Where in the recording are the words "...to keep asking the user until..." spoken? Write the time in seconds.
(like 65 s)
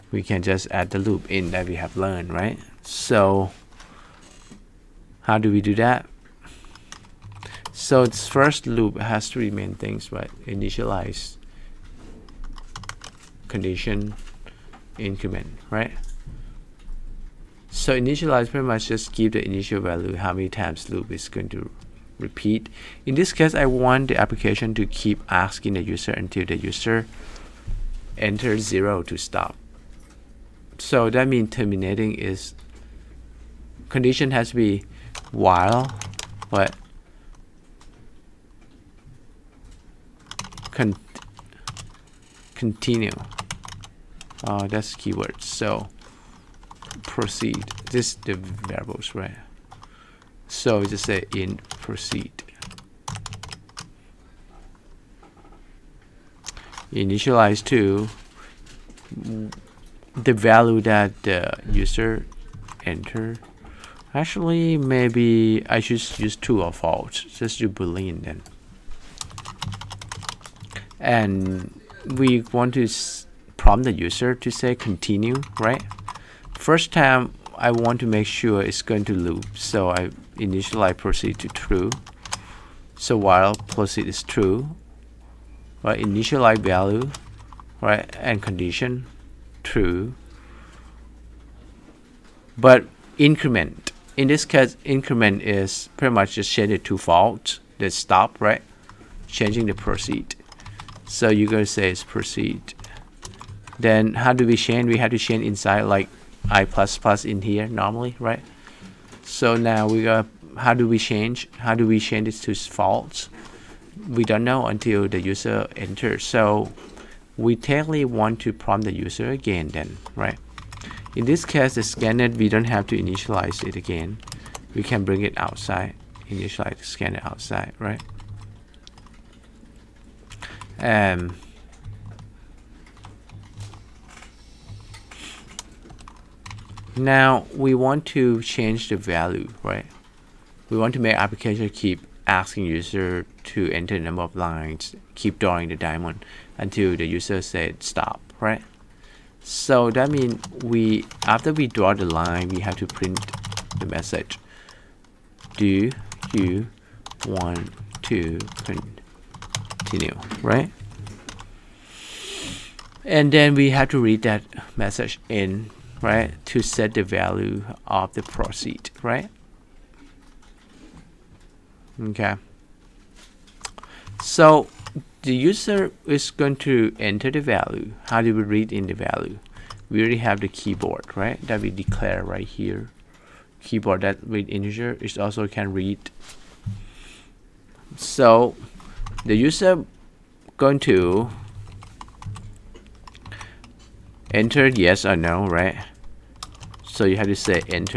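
24 s.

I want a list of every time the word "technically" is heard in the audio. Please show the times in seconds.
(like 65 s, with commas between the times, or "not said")
117 s.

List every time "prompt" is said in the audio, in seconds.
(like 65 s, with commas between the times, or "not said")
73 s, 118 s.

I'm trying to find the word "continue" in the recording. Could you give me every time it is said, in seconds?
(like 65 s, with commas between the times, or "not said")
42 s, 74 s, 159 s.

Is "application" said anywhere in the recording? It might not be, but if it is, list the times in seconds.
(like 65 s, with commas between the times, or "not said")
24 s, 141 s.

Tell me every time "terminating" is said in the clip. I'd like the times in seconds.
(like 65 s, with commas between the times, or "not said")
31 s.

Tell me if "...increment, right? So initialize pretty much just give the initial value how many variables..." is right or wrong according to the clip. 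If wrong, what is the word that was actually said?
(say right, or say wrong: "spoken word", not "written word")
wrong: "times", not "variables".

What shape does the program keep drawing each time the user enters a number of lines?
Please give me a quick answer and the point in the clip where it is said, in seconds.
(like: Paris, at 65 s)
diamond, at 145 s.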